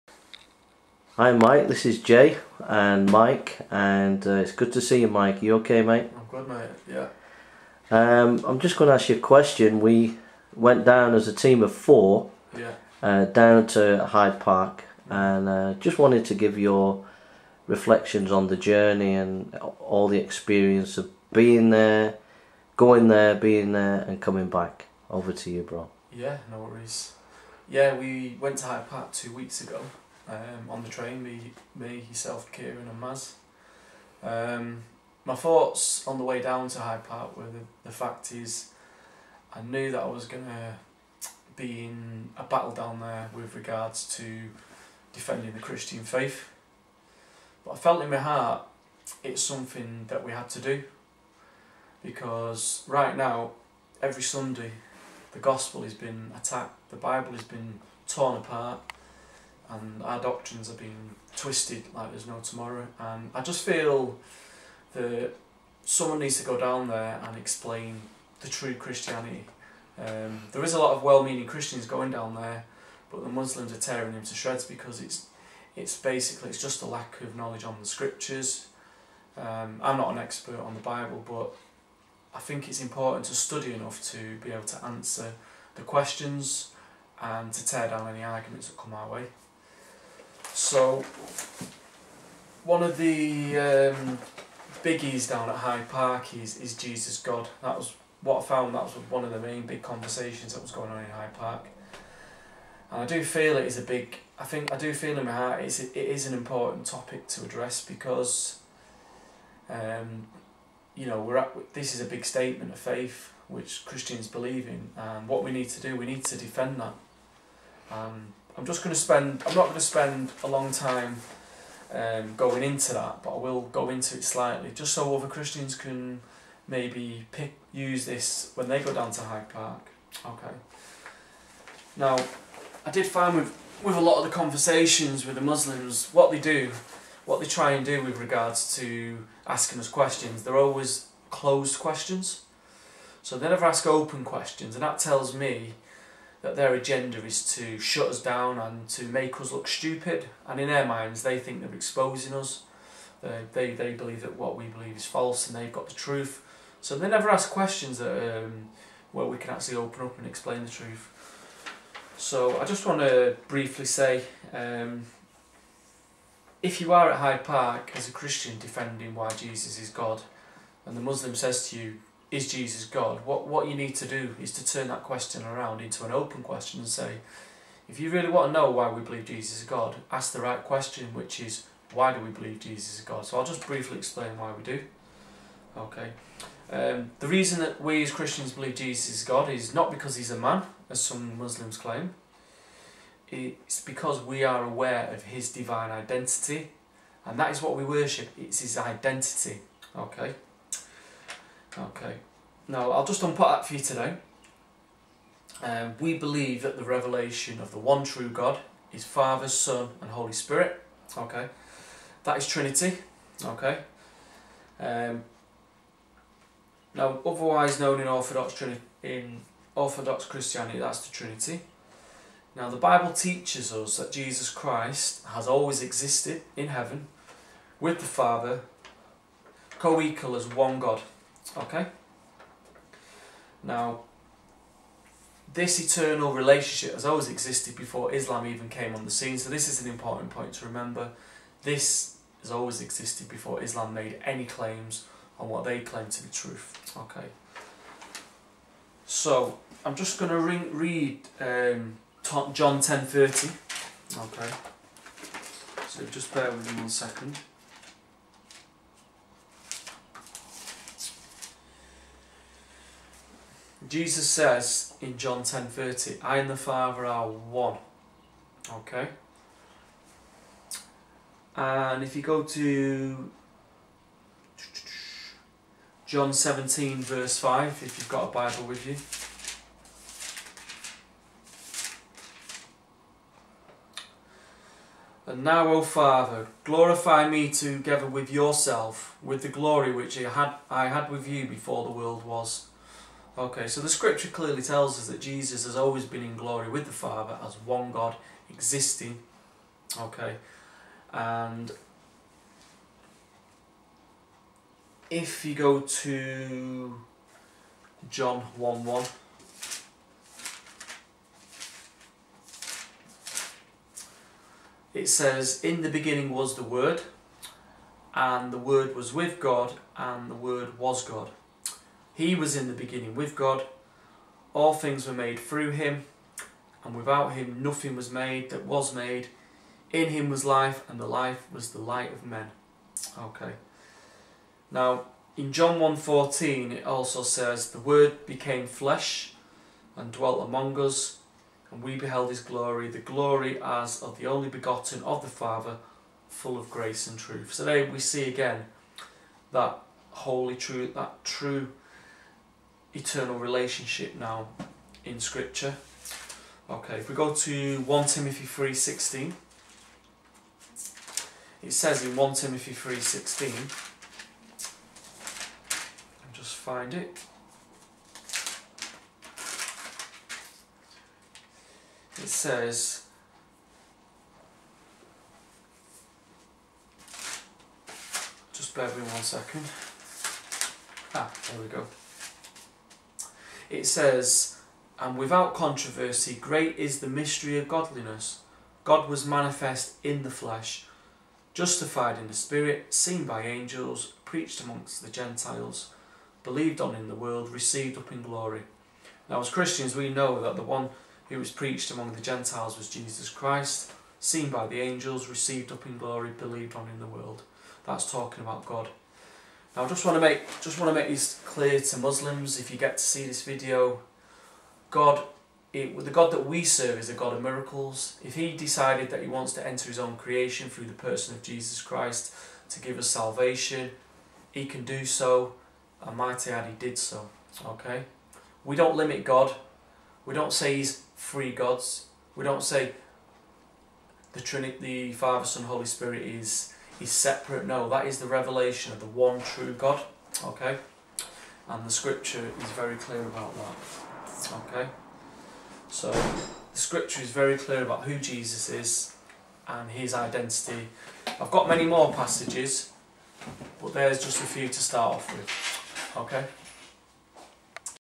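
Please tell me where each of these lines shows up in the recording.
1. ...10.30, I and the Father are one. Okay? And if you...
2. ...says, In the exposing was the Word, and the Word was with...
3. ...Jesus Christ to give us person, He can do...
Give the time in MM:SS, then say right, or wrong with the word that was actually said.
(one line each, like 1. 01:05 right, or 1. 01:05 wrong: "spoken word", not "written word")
1. 04:25 right
2. 05:15 wrong: "beginning", not "exposing"
3. 07:01 wrong: "salvation", not "person".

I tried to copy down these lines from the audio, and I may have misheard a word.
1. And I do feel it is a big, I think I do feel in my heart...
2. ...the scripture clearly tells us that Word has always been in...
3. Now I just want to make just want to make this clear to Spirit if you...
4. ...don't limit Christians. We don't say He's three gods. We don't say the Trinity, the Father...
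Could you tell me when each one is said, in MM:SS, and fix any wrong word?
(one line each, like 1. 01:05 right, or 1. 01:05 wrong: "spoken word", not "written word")
1. 01:42 right
2. 04:53 wrong: "Jesus", not "Word"
3. 06:49 wrong: "Muslims", not "Spirit"
4. 07:08 wrong: "God", not "Christians".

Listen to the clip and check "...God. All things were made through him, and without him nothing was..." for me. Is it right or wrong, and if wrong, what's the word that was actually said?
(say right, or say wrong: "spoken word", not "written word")
right.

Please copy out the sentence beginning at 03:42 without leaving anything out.
Now, the Bible teaches us that Jesus Christ has always existed in heaven with the Father, co equal as one God.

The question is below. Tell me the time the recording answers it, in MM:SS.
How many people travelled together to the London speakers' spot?
00:11.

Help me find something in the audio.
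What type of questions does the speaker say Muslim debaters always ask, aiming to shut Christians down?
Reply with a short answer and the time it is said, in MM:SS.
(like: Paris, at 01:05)
Closed questions, at 02:21.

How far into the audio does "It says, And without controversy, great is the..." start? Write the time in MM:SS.
06:23.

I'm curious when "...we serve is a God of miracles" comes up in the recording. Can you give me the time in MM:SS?
06:56.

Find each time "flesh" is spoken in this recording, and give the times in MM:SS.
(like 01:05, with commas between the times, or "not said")
05:38, 06:30.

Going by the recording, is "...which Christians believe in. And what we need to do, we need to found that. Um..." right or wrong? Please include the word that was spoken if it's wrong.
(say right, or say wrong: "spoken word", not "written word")
wrong: "defend", not "found".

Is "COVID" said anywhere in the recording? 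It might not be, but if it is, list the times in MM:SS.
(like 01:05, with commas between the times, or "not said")
not said.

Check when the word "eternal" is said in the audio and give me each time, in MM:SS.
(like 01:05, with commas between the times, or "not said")
03:55, 05:52.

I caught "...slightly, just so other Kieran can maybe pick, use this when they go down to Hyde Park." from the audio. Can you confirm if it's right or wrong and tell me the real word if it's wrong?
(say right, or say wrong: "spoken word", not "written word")
wrong: "Christians", not "Kieran".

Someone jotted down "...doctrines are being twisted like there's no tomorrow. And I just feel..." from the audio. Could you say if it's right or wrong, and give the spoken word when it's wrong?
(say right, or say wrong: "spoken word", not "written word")
right.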